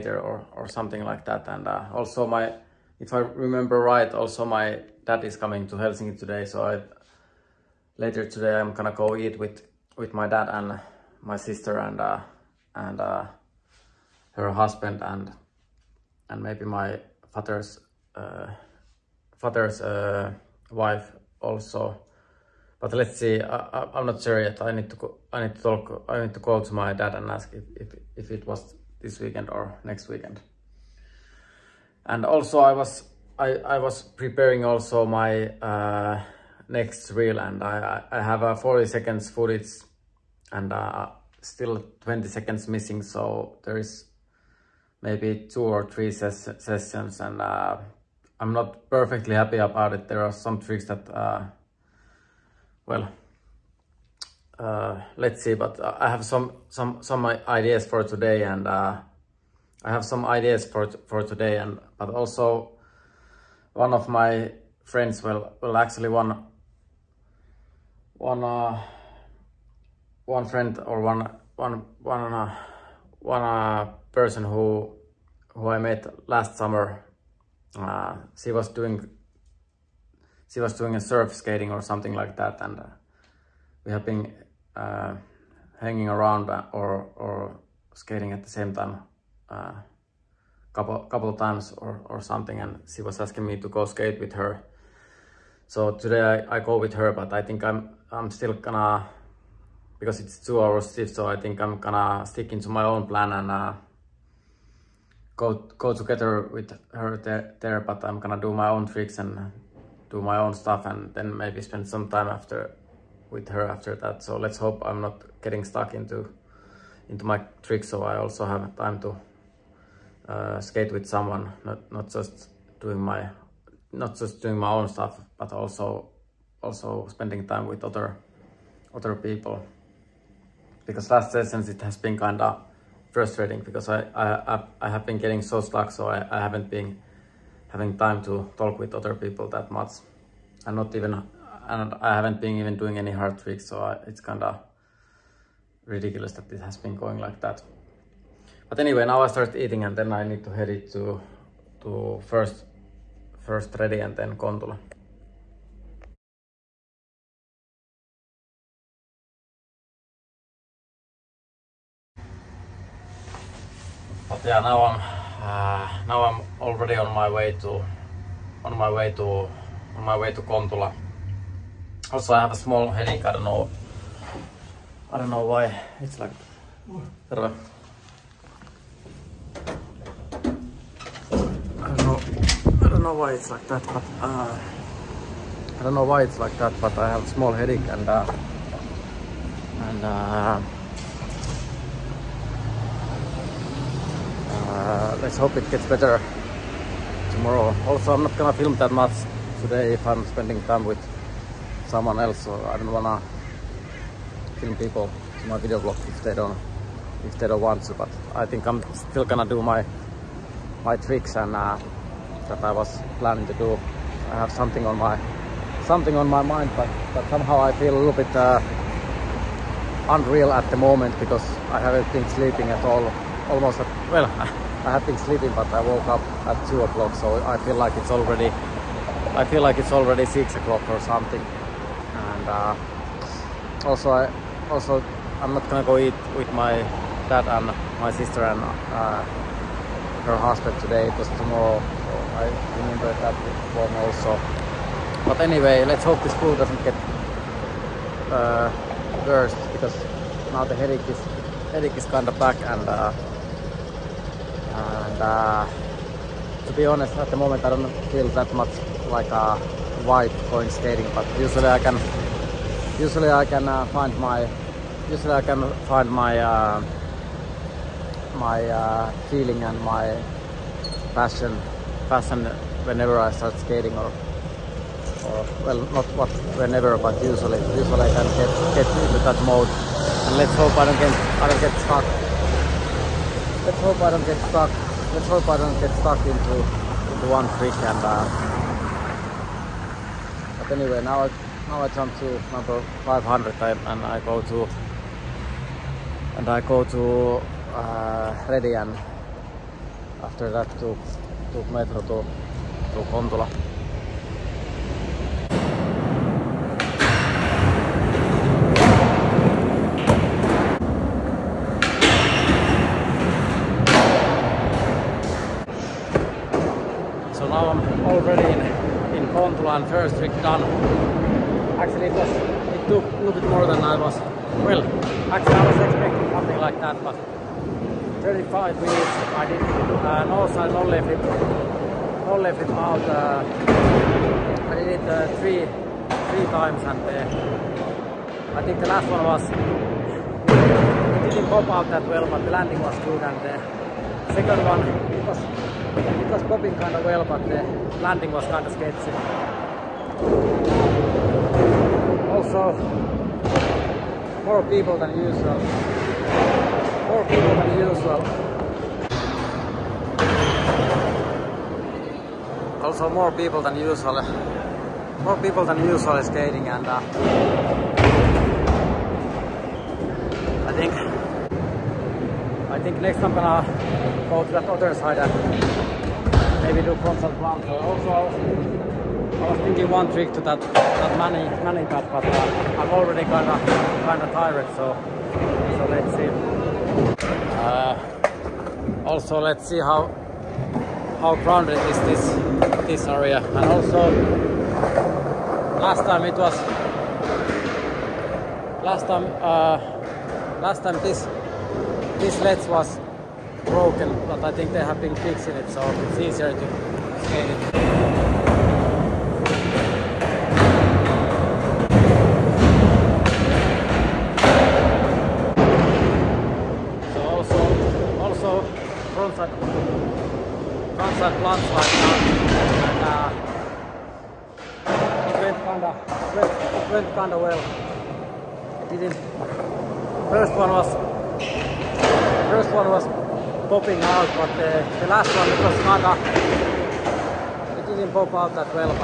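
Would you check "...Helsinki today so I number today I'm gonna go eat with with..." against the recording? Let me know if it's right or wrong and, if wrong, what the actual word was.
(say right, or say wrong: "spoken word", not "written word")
wrong: "later", not "number".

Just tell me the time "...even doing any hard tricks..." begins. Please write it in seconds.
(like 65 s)
142 s.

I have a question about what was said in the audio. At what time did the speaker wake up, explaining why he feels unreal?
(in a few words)
2 o'clock.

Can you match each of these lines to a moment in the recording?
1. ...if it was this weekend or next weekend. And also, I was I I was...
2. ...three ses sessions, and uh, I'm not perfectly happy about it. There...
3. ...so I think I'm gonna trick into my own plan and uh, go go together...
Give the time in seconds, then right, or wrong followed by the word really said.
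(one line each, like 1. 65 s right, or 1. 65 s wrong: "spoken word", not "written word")
1. 28 s right
2. 45 s right
3. 101 s wrong: "stick", not "trick".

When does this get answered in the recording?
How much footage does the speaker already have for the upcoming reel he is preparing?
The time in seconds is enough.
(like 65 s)
38 s.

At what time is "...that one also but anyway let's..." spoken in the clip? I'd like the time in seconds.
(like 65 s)
243 s.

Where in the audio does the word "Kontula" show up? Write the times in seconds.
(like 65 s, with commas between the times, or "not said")
154 s, 170 s, 303 s.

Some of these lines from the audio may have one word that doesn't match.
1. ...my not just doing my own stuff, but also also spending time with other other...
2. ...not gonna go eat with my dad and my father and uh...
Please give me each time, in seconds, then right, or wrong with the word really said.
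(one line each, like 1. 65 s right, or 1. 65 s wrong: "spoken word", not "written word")
1. 122 s right
2. 235 s wrong: "sister", not "father".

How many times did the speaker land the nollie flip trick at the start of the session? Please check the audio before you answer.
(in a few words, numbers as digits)
3.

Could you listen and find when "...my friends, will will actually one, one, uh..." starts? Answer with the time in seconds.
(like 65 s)
64 s.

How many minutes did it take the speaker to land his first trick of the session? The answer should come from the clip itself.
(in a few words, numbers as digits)
35.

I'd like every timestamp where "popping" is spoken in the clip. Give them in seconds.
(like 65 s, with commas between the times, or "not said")
346 s, 433 s.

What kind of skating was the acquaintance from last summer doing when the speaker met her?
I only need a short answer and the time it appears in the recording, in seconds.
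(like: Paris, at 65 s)
surf skating, at 80 s.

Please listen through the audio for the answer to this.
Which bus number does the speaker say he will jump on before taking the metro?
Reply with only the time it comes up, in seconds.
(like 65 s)
293 s.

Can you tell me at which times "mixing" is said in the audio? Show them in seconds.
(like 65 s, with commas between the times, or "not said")
not said.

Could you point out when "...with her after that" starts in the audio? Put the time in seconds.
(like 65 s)
113 s.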